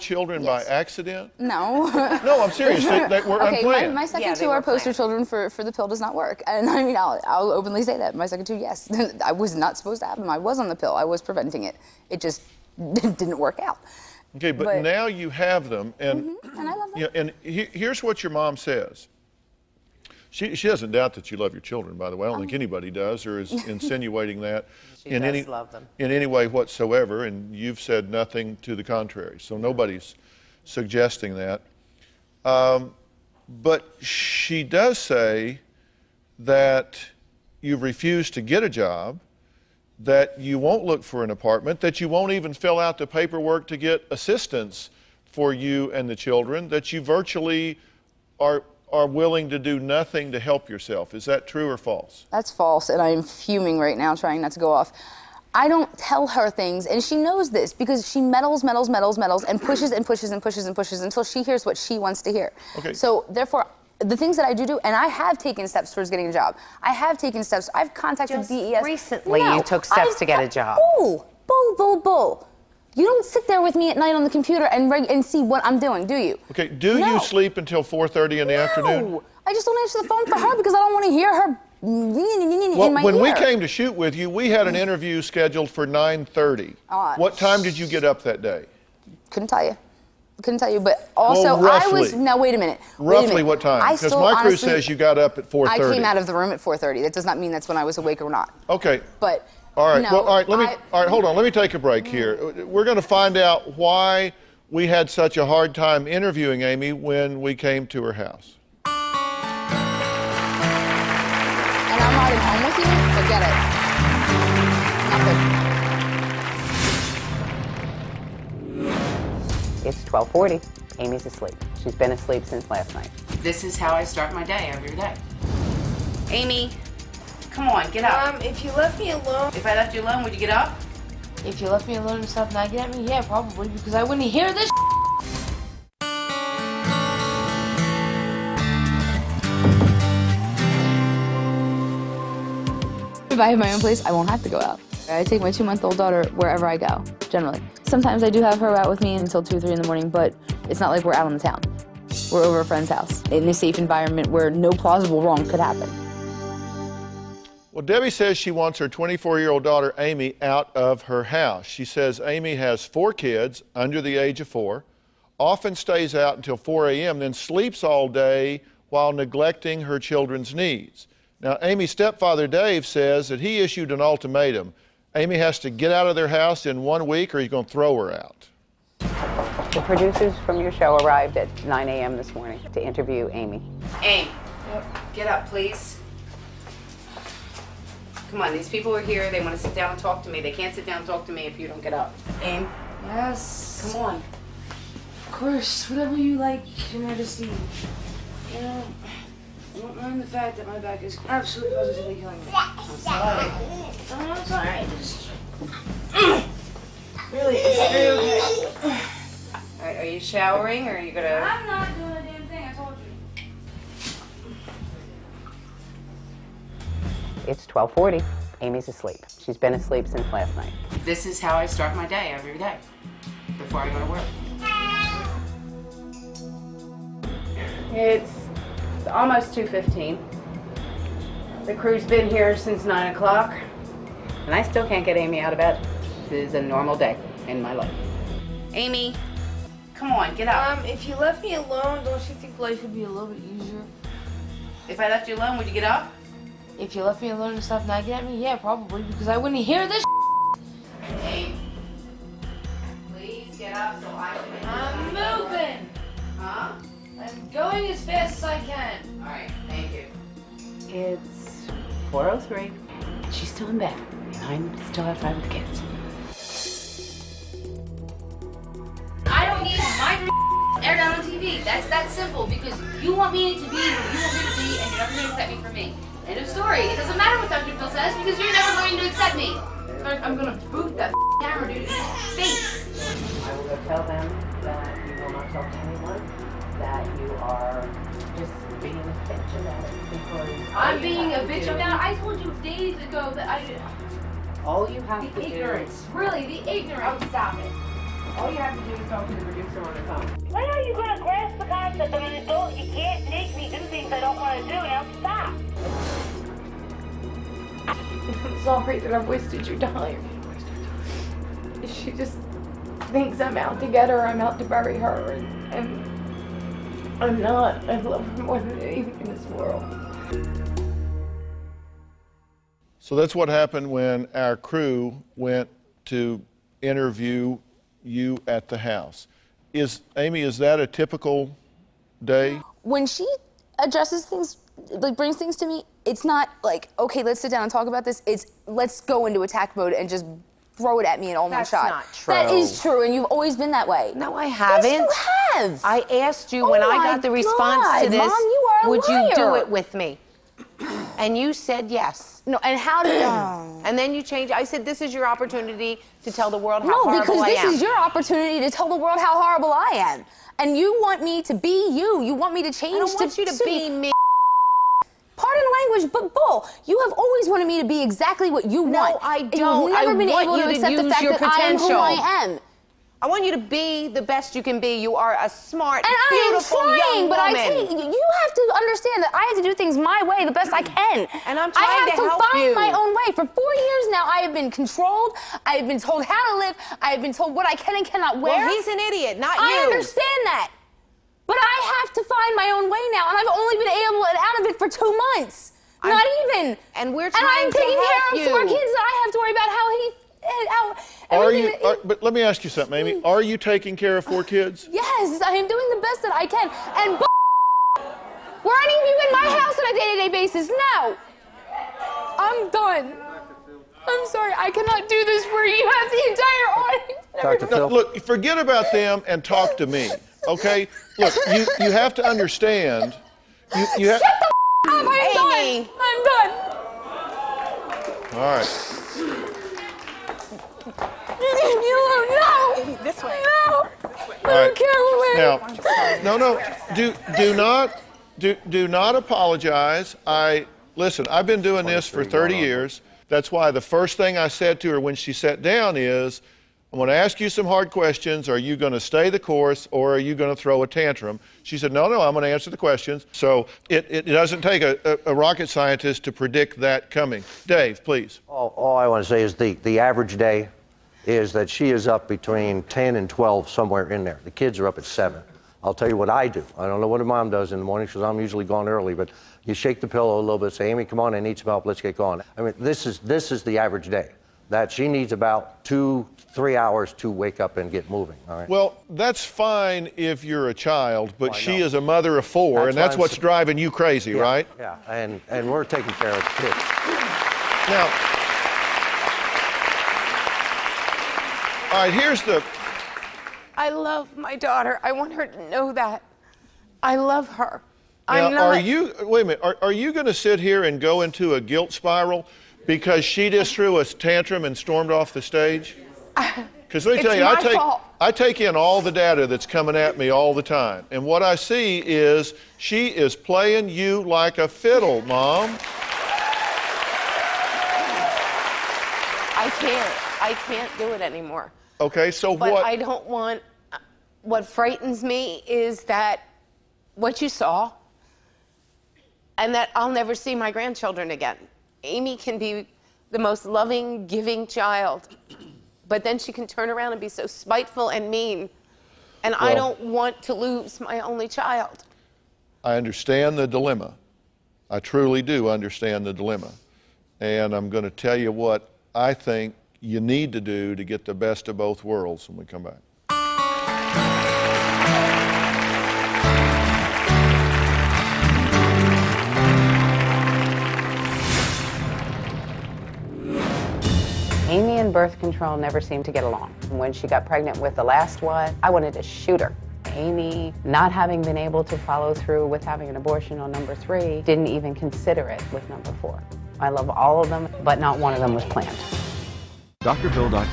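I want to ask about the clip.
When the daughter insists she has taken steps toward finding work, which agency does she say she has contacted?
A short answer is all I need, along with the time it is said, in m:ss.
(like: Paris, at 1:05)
DES, at 1:08.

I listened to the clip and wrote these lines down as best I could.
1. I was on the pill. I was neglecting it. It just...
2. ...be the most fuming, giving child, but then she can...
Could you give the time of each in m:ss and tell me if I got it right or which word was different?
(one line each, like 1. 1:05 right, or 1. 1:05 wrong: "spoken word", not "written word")
1. 0:10 wrong: "preventing", not "neglecting"
2. 8:52 wrong: "loving", not "fuming".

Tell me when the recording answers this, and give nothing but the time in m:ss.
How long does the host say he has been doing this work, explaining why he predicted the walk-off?
7:22.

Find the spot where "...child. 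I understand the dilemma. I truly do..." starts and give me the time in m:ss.
9:01.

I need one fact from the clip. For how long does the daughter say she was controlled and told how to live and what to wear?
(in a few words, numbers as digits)
Four years.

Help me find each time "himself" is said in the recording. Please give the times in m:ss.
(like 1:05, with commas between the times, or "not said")
not said.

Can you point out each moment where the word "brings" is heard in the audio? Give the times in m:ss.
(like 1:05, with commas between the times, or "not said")
5:35.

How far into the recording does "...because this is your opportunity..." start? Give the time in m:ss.
5:57.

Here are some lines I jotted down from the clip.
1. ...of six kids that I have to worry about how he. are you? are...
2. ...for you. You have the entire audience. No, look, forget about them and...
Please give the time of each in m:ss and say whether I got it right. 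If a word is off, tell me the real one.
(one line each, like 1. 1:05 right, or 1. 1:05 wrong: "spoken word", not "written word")
1. 6:38 wrong: "four", not "six"
2. 6:55 right.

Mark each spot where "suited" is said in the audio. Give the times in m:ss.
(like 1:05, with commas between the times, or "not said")
not said.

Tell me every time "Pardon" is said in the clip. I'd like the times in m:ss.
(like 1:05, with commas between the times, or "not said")
6:05.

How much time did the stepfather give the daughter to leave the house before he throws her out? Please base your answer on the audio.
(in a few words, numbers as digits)
One week.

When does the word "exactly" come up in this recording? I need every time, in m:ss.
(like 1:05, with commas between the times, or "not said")
6:08.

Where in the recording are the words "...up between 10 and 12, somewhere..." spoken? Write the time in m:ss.
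7:42.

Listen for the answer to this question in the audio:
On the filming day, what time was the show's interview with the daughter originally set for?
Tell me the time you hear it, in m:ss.
1:25.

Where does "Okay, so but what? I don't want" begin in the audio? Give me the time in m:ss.
8:41.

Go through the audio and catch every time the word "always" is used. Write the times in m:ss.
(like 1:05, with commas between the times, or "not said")
5:43, 6:07.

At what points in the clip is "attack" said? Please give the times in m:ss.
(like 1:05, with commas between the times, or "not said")
5:39.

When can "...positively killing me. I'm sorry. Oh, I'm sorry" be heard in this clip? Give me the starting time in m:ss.
3:21.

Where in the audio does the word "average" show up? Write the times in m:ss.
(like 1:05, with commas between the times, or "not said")
7:39, 7:53.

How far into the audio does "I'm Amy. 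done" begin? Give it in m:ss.
7:05.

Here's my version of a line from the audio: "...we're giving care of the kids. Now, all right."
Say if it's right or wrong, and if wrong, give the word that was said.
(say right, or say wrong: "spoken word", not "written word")
wrong: "taking", not "giving".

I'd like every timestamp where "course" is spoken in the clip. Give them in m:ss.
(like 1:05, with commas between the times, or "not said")
3:15, 7:29.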